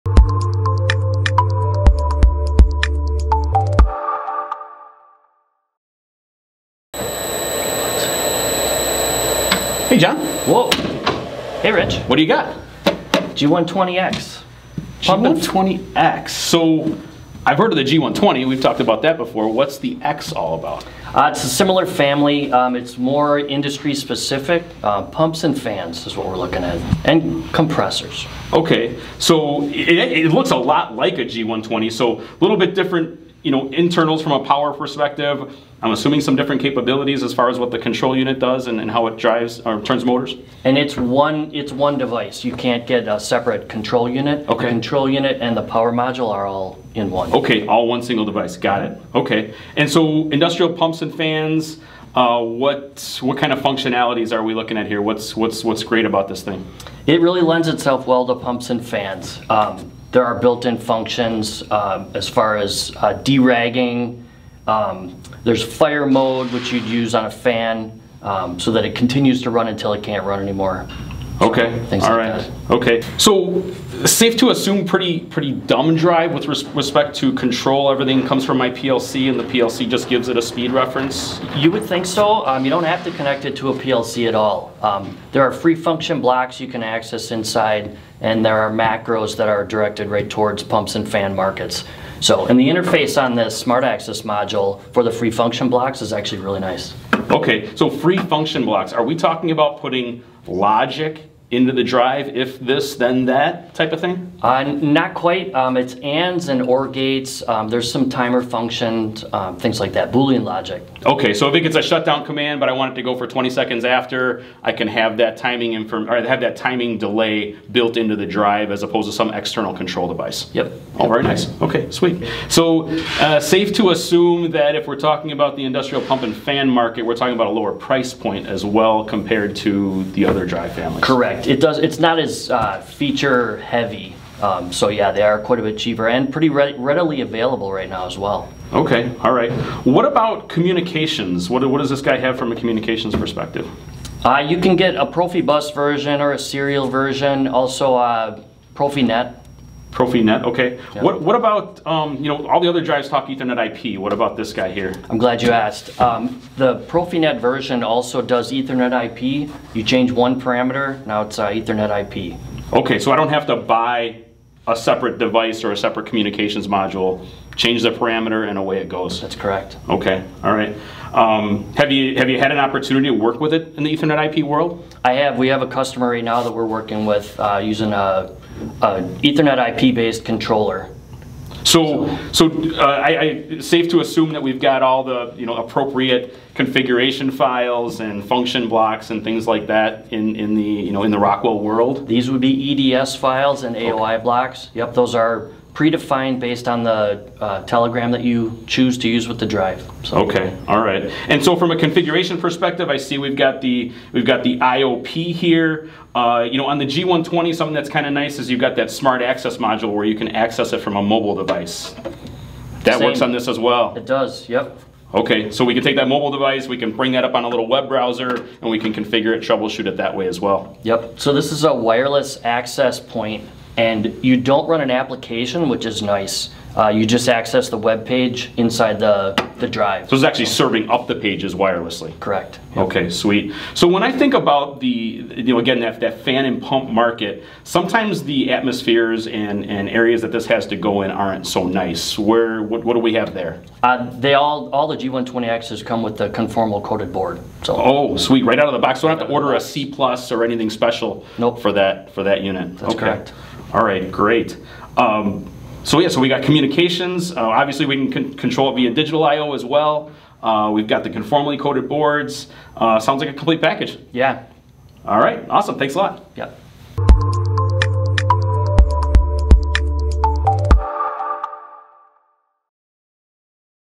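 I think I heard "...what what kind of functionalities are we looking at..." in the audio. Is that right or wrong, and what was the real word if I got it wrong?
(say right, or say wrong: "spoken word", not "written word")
right.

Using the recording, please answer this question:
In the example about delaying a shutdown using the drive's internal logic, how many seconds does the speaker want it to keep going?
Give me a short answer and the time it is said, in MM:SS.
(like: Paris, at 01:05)
20, at 01:53.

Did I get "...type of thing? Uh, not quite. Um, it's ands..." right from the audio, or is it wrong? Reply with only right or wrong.
right.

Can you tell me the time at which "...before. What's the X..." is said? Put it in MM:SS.
00:19.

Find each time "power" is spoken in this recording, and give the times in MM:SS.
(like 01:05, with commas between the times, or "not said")
00:34, 00:45.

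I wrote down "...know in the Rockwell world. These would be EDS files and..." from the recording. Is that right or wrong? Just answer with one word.
right.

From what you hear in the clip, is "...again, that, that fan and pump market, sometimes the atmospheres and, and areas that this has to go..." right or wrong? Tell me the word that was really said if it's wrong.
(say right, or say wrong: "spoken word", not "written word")
right.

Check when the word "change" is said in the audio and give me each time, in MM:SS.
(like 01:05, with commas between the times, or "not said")
02:39, 02:47.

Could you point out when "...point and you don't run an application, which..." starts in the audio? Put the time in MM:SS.
03:43.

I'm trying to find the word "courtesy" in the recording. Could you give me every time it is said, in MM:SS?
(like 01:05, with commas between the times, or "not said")
not said.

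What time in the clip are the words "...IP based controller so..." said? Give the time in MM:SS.
02:59.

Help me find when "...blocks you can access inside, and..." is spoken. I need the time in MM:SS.
01:26.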